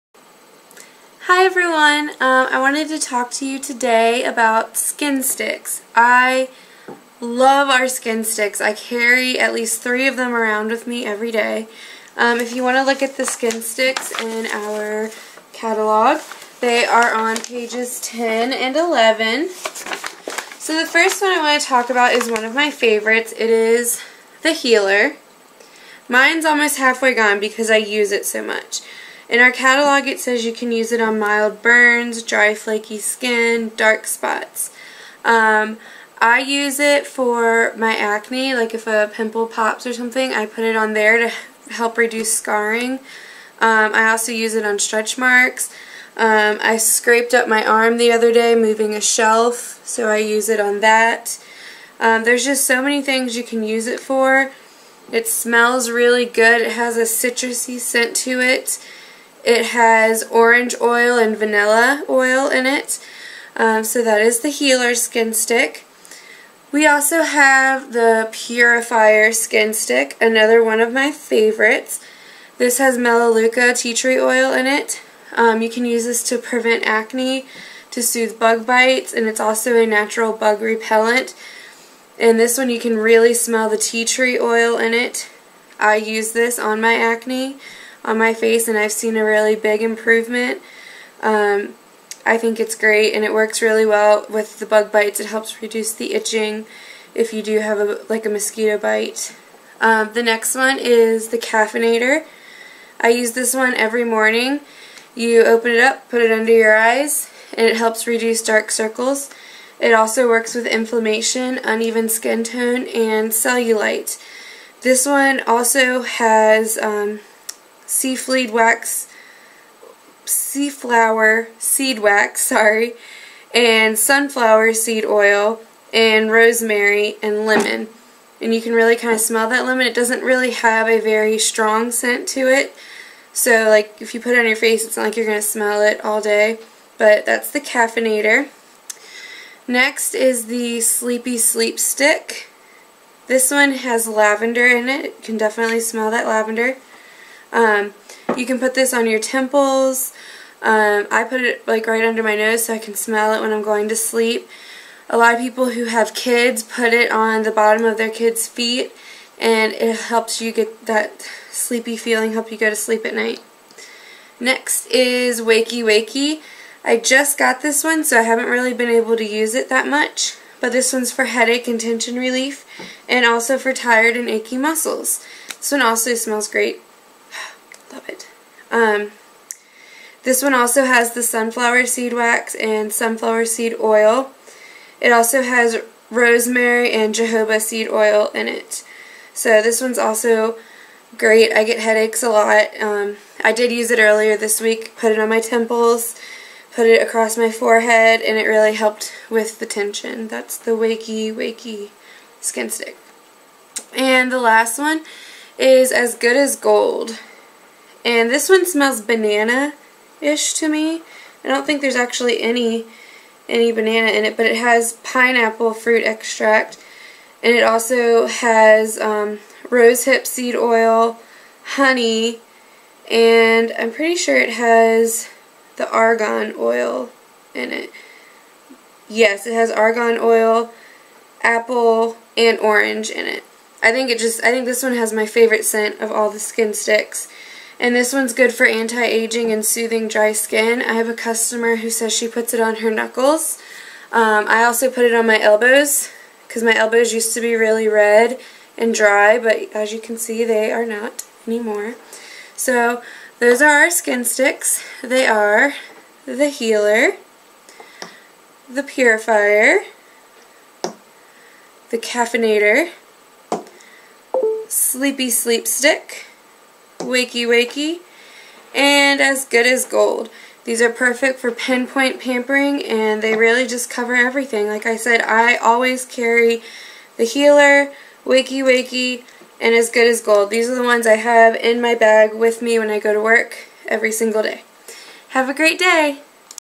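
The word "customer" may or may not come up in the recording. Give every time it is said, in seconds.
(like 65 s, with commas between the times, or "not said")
241 s.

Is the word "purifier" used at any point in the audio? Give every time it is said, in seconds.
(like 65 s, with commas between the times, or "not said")
68 s, 258 s.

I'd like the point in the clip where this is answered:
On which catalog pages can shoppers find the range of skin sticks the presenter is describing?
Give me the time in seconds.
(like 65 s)
17 s.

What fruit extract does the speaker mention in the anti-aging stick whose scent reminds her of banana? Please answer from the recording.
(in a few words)
Pineapple.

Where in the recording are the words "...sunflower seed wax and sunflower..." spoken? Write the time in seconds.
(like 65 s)
181 s.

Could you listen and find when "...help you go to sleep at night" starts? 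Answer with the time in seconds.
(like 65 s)
162 s.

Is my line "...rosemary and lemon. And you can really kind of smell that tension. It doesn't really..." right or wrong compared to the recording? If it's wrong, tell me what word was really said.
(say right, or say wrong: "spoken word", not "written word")
wrong: "lemon", not "tension".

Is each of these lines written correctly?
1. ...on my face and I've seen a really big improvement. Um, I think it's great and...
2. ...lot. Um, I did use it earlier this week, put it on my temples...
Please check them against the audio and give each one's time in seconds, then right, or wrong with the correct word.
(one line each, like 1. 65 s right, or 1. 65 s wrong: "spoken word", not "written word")
1. 88 s right
2. 192 s right.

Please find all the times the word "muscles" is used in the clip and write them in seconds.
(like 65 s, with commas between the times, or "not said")
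174 s.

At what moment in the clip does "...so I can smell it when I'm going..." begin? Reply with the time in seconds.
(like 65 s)
152 s.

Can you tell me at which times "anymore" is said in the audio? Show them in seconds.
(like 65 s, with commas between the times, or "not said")
251 s.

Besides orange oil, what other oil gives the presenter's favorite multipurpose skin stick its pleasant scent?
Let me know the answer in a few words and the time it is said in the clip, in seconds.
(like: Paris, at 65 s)
Vanilla oil, at 61 s.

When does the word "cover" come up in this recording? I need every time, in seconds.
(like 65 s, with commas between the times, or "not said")
273 s.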